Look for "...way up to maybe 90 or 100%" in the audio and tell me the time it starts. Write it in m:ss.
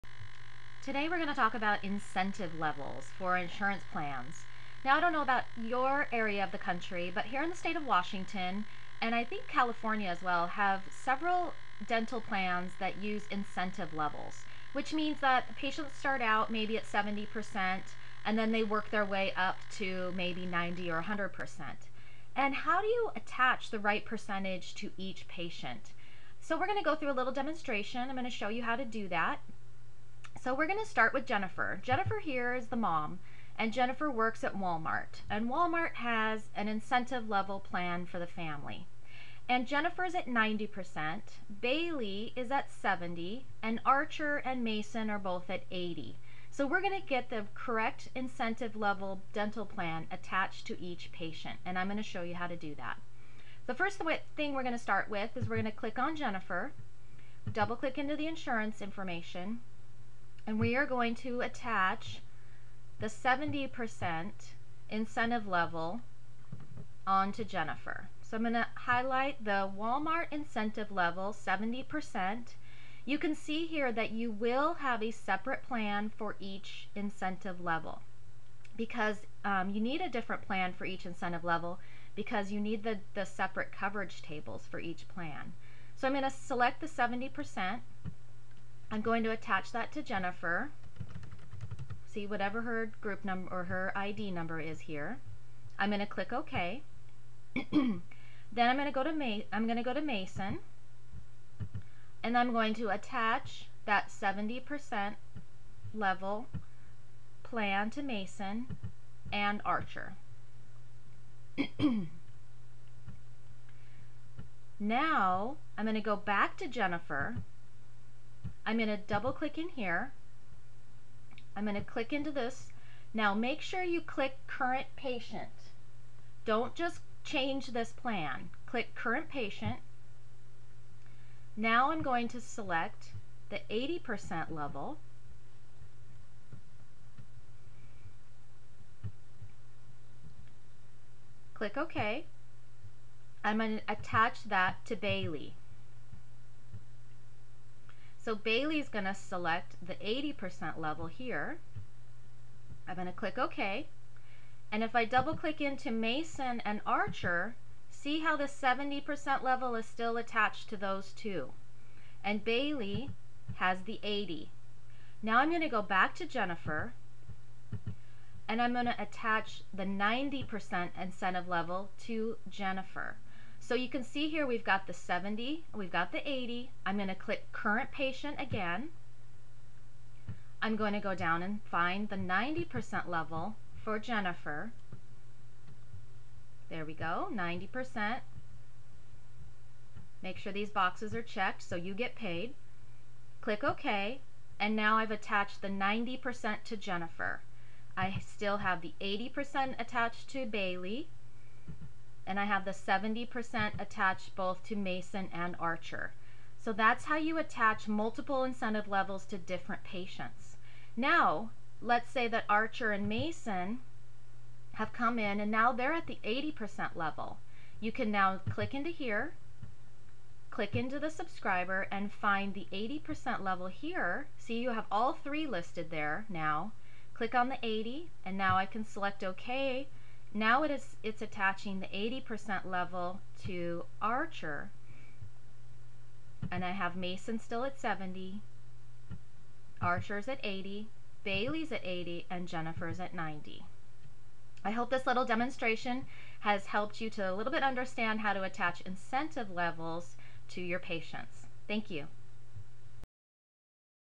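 0:19.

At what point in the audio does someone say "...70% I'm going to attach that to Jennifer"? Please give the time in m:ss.
1:26.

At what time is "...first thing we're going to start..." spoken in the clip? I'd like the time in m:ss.
0:53.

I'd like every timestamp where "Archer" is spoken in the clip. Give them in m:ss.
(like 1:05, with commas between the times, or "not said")
0:43, 1:49, 2:36, 3:25, 3:32, 3:54, 3:59.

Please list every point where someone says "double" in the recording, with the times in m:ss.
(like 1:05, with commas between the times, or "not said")
0:57, 1:58, 2:35.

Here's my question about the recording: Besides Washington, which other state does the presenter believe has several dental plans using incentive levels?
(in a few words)
California.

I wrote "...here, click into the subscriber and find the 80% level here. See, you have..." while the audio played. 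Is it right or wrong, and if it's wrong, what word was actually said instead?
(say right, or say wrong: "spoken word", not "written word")
right.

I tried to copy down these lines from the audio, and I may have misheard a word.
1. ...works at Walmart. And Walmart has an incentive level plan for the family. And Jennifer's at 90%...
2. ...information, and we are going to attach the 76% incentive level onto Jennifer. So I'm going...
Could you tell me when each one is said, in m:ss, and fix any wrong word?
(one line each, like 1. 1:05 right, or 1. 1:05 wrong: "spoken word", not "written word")
1. 0:34 right
2. 0:58 wrong: "70", not "76".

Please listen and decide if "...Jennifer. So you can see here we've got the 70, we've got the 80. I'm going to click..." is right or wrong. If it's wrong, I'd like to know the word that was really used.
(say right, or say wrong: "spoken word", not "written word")
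right.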